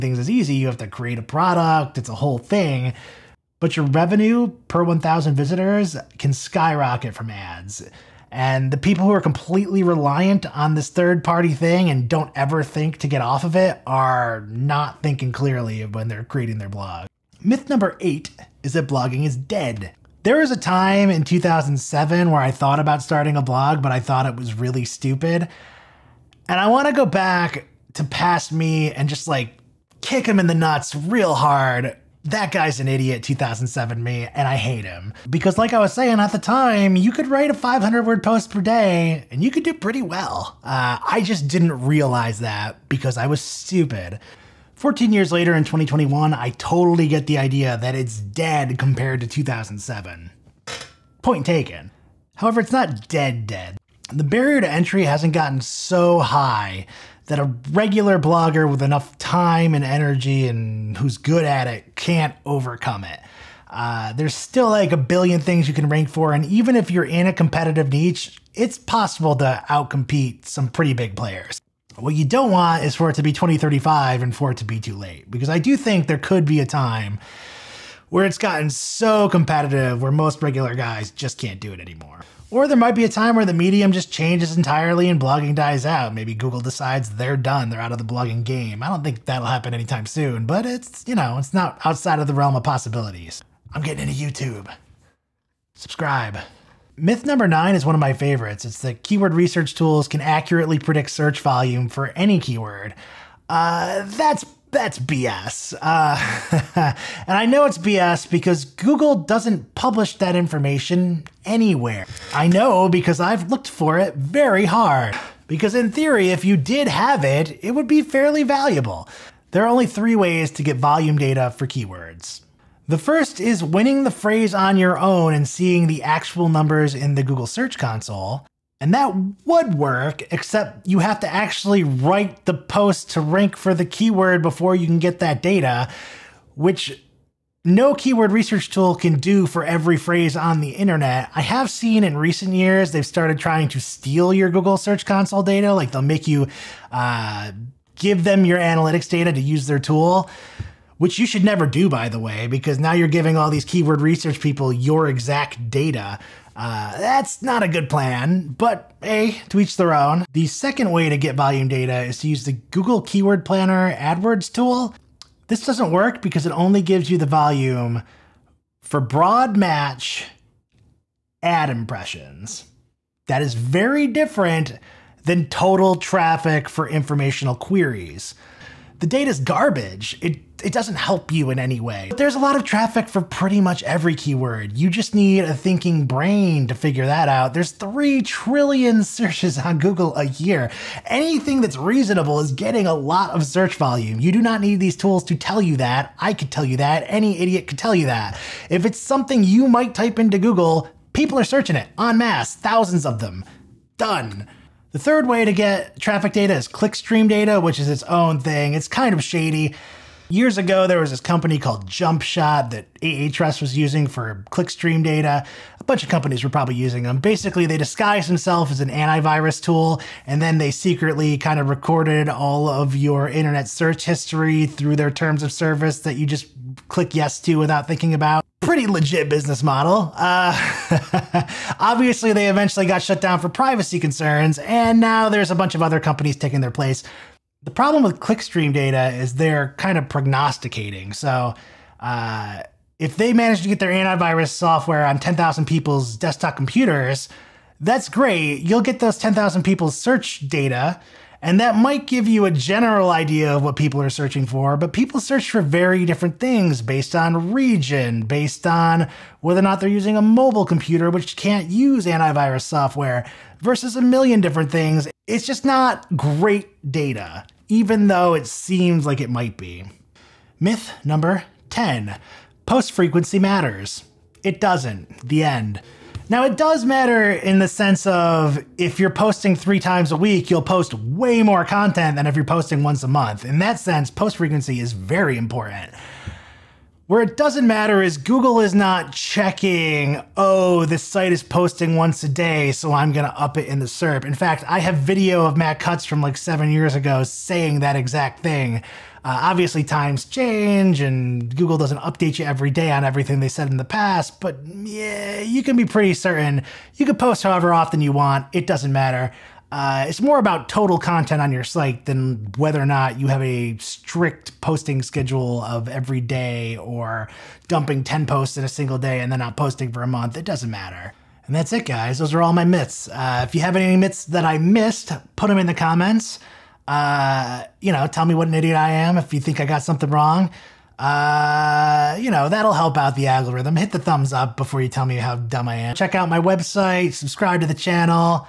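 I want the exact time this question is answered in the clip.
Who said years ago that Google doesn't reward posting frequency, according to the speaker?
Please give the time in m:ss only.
4:55.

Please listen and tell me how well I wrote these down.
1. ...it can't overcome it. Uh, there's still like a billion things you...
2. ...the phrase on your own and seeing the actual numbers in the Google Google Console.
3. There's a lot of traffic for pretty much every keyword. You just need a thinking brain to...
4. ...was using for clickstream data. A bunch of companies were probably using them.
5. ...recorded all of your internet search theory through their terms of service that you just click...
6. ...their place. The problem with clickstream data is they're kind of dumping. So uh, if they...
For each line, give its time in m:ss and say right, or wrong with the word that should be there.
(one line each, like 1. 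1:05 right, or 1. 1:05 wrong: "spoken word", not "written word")
1. 1:01 right
2. 2:04 wrong: "Search", not "Google"
3. 3:02 right
4. 3:33 right
5. 3:41 wrong: "history", not "theory"
6. 3:56 wrong: "prognosticating", not "dumping".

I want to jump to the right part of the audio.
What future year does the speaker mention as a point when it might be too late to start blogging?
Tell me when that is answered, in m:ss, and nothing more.
1:13.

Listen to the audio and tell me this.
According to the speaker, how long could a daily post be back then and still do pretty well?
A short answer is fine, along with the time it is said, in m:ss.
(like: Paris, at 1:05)
500 words, at 0:37.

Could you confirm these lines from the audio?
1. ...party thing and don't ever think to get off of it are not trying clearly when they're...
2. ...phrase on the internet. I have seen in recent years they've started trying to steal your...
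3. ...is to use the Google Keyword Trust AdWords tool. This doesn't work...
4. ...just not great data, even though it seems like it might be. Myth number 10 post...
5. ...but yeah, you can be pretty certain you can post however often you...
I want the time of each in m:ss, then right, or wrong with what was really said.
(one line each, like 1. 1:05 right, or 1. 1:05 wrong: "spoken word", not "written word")
1. 0:11 wrong: "thinking", not "trying"
2. 2:19 right
3. 2:42 wrong: "Planner", not "Trust"
4. 4:25 right
5. 5:04 right.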